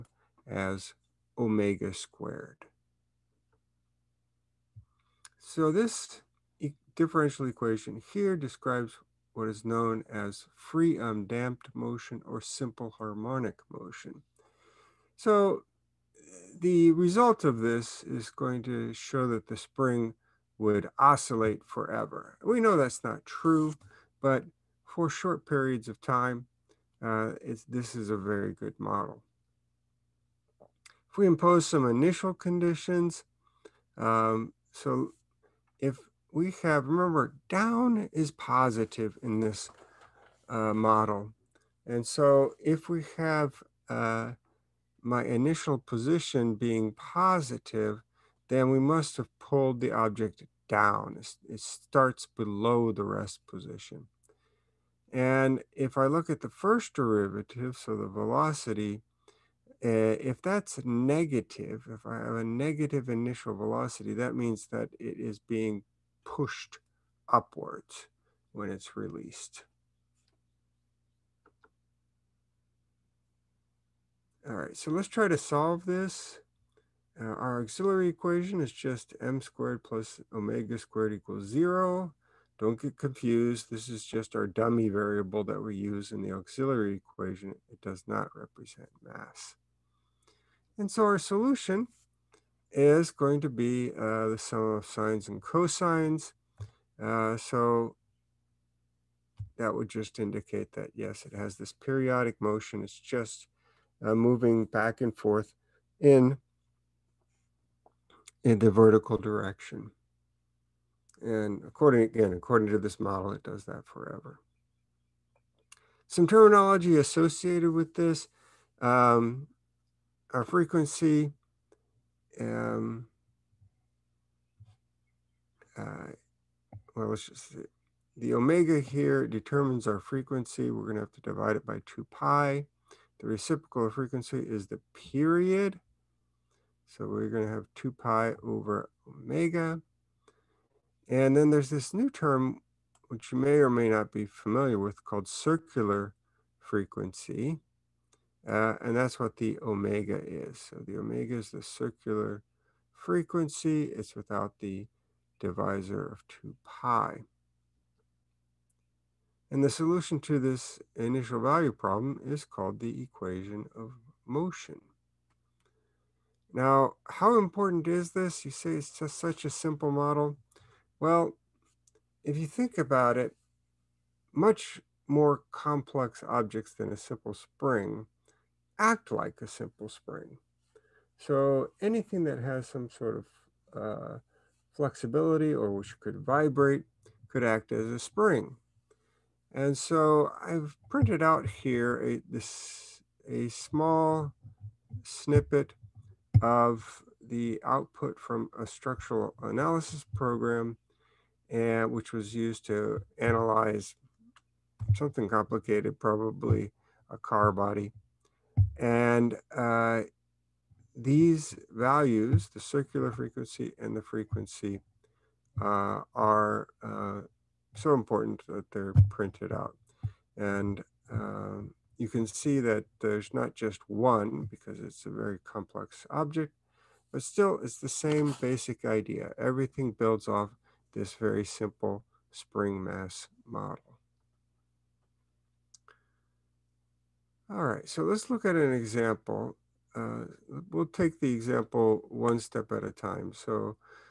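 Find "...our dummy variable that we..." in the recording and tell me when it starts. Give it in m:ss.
1:24.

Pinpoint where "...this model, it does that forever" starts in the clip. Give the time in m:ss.
1:52.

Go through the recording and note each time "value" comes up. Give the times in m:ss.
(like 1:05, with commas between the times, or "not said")
2:41, 3:31.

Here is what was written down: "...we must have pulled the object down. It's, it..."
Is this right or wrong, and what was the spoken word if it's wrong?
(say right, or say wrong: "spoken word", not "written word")
right.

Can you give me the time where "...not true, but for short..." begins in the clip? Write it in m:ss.
0:23.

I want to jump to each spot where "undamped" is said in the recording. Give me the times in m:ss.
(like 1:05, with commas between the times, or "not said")
0:10.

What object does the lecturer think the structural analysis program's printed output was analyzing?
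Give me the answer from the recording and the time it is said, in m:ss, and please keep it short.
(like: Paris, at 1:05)
A car body, at 3:27.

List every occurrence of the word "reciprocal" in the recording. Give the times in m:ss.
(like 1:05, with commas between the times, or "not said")
2:13.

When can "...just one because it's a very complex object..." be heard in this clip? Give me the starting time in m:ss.
3:43.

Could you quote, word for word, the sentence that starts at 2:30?
So the omega is the circular frequency.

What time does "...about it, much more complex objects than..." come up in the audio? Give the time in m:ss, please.
2:52.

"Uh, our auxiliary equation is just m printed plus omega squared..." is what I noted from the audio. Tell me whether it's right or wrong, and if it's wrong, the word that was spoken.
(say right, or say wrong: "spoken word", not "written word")
wrong: "squared", not "printed".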